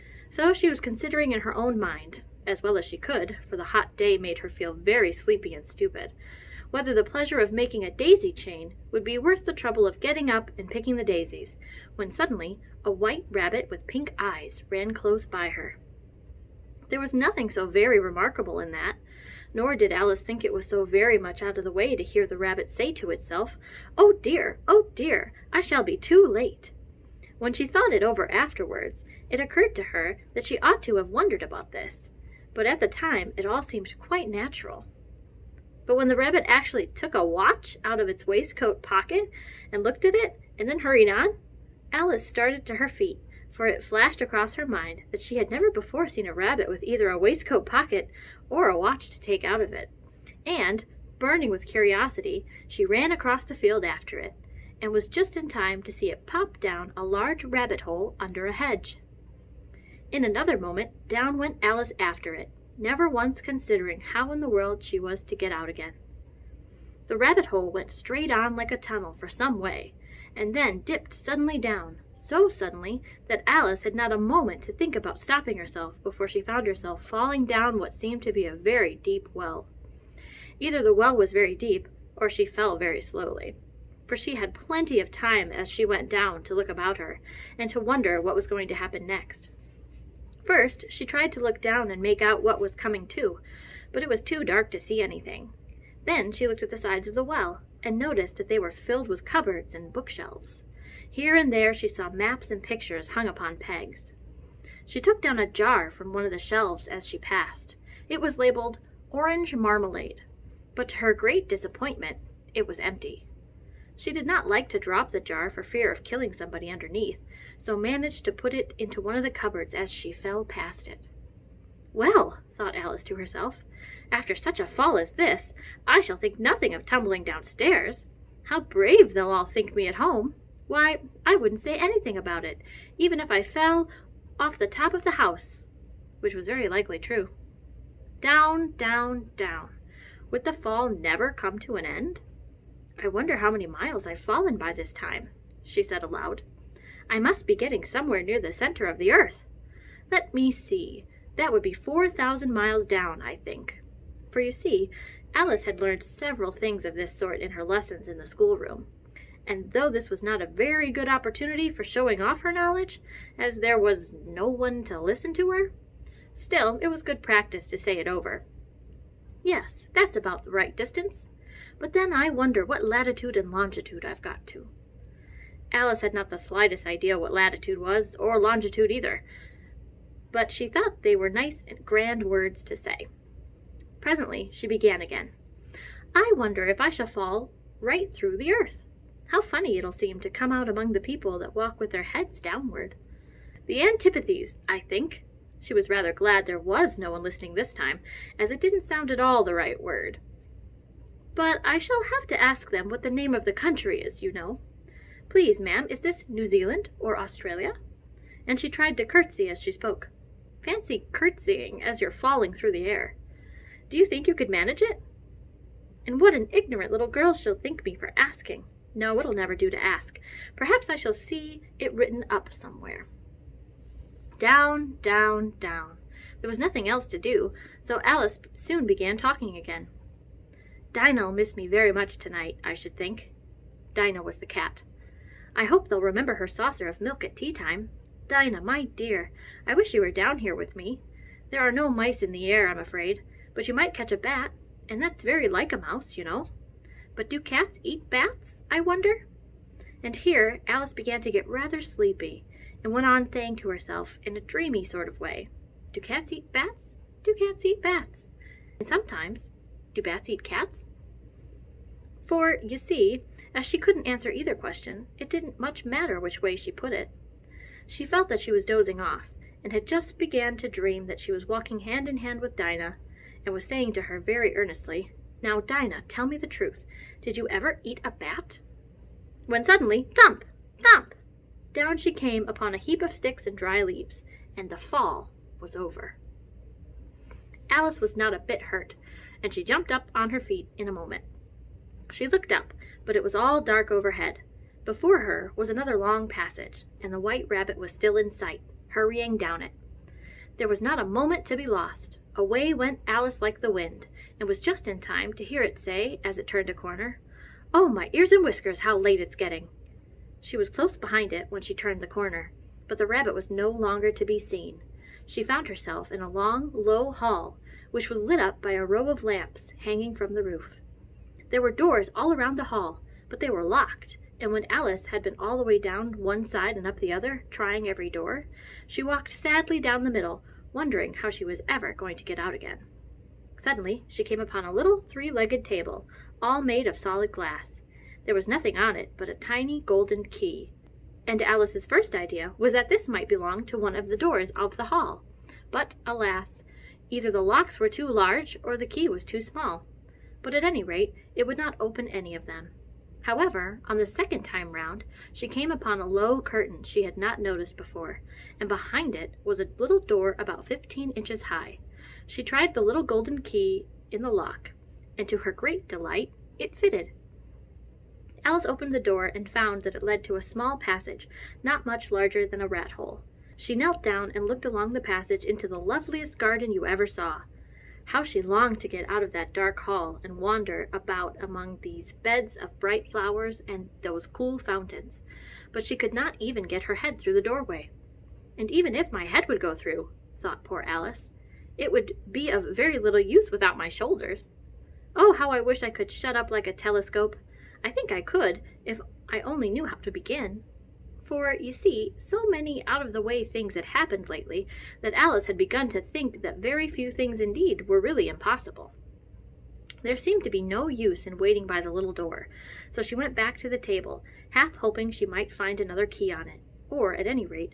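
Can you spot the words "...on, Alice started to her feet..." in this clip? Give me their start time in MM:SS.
00:41.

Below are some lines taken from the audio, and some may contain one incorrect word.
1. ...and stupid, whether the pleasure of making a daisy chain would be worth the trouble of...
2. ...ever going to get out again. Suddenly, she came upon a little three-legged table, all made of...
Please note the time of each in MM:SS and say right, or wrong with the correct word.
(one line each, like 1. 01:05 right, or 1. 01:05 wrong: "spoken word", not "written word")
1. 00:05 right
2. 05:31 right.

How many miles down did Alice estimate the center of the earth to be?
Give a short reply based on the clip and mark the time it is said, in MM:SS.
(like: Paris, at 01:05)
4,000, at 02:31.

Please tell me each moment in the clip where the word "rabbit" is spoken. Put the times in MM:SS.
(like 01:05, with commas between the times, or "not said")
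00:13, 00:22, 00:36, 00:46, 00:57, 01:07, 04:57, 05:13.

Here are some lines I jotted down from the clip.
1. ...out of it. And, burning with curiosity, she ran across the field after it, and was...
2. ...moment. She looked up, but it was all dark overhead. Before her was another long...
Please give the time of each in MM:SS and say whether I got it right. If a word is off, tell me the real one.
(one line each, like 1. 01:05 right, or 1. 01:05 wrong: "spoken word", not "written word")
1. 00:49 right
2. 04:50 right.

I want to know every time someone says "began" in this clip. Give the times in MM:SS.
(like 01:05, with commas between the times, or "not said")
03:04, 03:48, 04:10, 04:30.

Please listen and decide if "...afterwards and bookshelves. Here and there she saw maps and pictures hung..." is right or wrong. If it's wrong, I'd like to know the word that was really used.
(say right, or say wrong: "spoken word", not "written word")
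wrong: "cupboards", not "afterwards".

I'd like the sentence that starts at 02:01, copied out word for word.
Well, thought Alice to herself, after such a fall as this, I shall think nothing of tumbling downstairs.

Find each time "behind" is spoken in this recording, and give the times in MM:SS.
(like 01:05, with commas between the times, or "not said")
05:10, 05:58.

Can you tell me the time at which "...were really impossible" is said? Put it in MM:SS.
06:47.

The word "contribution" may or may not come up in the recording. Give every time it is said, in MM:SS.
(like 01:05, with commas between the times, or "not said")
not said.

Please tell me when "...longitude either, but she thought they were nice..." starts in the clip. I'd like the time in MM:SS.
02:58.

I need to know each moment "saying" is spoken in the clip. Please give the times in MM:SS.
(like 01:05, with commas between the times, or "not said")
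04:13, 04:33.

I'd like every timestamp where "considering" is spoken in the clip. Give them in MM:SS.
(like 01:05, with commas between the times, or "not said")
00:00, 01:03.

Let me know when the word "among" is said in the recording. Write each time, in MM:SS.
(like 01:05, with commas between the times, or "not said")
03:10, 06:21.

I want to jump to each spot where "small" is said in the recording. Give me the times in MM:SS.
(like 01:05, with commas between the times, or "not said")
05:49, 06:10.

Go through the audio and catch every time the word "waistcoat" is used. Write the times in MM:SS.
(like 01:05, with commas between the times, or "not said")
00:38, 00:47.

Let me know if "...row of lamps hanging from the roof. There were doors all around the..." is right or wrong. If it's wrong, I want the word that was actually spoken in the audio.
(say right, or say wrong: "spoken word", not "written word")
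right.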